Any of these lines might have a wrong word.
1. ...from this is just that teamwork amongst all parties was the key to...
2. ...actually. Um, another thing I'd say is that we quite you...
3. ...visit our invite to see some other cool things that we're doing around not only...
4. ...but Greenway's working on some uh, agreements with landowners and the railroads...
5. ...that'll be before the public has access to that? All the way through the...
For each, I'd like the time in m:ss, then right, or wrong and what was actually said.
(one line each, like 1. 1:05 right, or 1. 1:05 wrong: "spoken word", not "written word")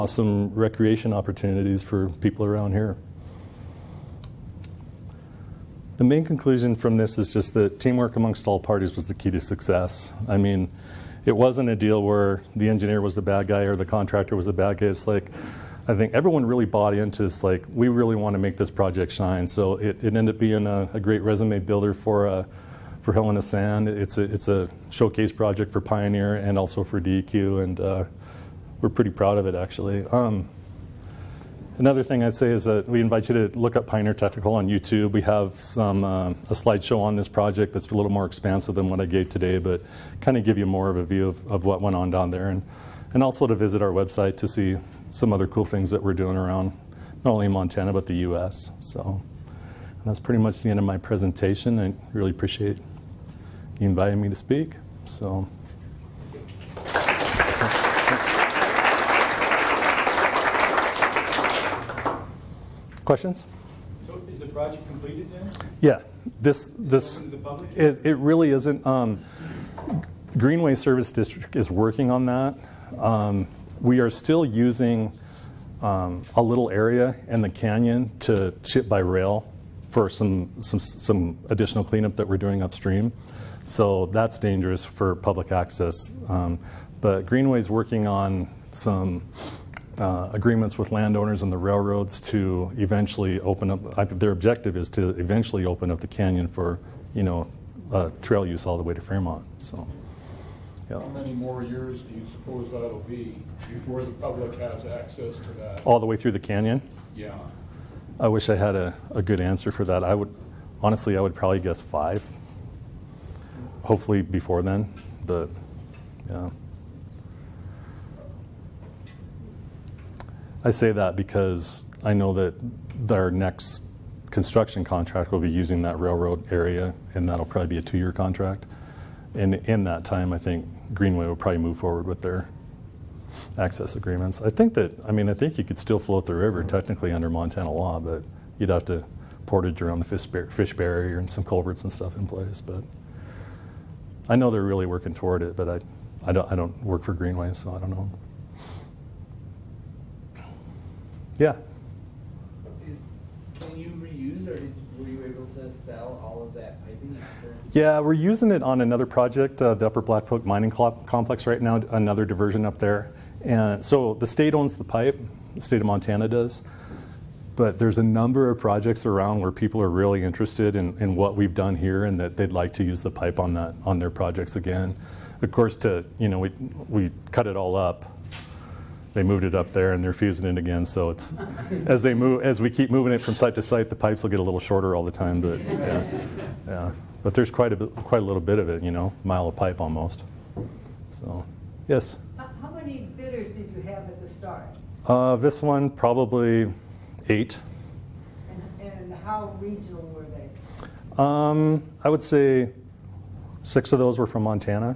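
1. 0:06 right
2. 0:29 wrong: "invite", not "quite"
3. 0:43 wrong: "website", not "invite"
4. 1:26 right
5. 1:42 right.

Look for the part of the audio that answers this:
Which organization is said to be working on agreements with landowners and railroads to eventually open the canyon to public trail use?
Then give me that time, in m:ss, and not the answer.
1:10.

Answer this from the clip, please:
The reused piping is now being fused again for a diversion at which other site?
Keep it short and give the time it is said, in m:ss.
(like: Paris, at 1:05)
Upper Blackfoot Mining Complex, at 2:39.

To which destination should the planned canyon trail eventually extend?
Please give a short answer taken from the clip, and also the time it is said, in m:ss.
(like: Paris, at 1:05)
Fairmont, at 1:39.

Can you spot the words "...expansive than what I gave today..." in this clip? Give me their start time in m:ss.
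0:38.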